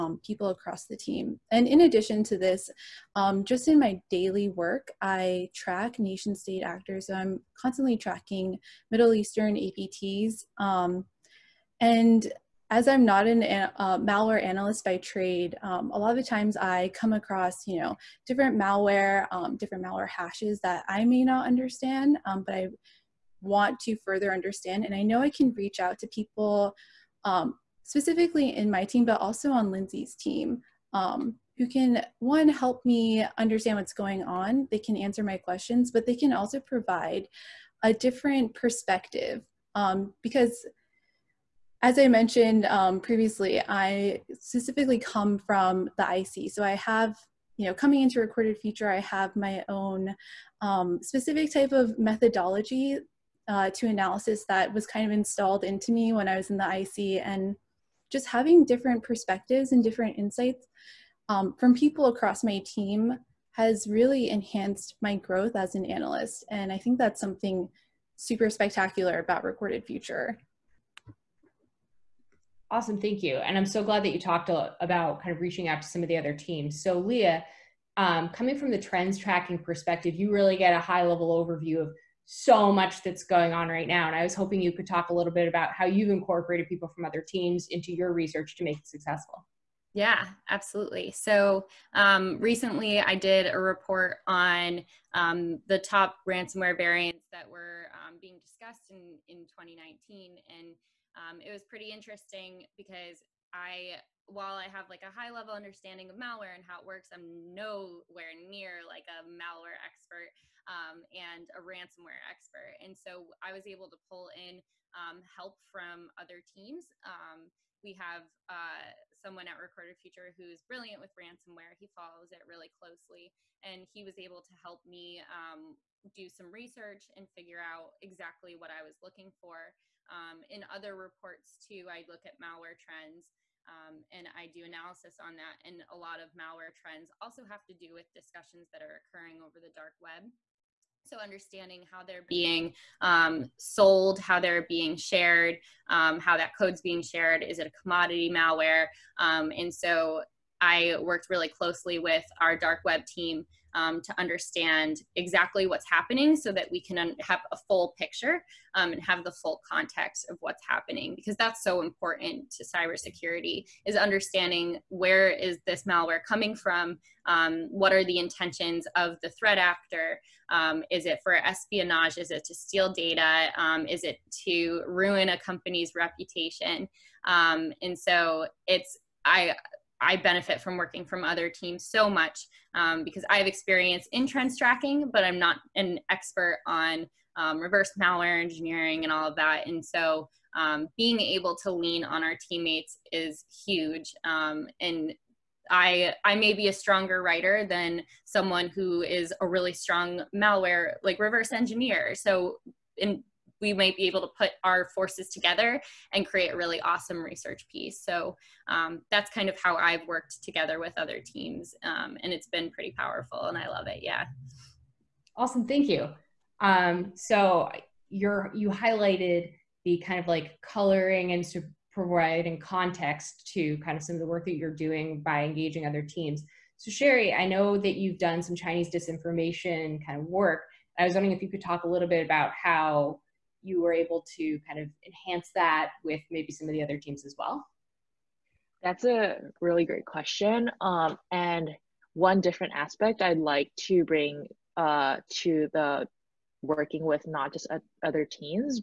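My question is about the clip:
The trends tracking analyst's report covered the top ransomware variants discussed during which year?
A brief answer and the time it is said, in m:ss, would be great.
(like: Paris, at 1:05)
2019, at 1:39.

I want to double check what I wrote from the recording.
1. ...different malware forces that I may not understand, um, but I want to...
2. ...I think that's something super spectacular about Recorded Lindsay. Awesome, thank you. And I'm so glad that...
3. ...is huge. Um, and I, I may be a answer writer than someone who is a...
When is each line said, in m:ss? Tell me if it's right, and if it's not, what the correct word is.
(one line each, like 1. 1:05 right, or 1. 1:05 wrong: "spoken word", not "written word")
1. 0:19 wrong: "hashes", not "forces"
2. 1:06 wrong: "Future", not "Lindsay"
3. 3:13 wrong: "stronger", not "answer".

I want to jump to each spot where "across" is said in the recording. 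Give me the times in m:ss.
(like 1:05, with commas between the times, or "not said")
0:00, 0:17, 1:02.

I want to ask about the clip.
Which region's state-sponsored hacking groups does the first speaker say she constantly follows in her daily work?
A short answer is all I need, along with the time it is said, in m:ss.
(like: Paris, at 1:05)
Middle Eastern, at 0:08.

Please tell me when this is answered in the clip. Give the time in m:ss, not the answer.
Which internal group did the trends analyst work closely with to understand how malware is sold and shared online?
2:32.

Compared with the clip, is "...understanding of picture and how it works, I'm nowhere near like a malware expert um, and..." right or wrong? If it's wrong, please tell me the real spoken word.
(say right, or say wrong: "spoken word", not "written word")
wrong: "malware", not "picture".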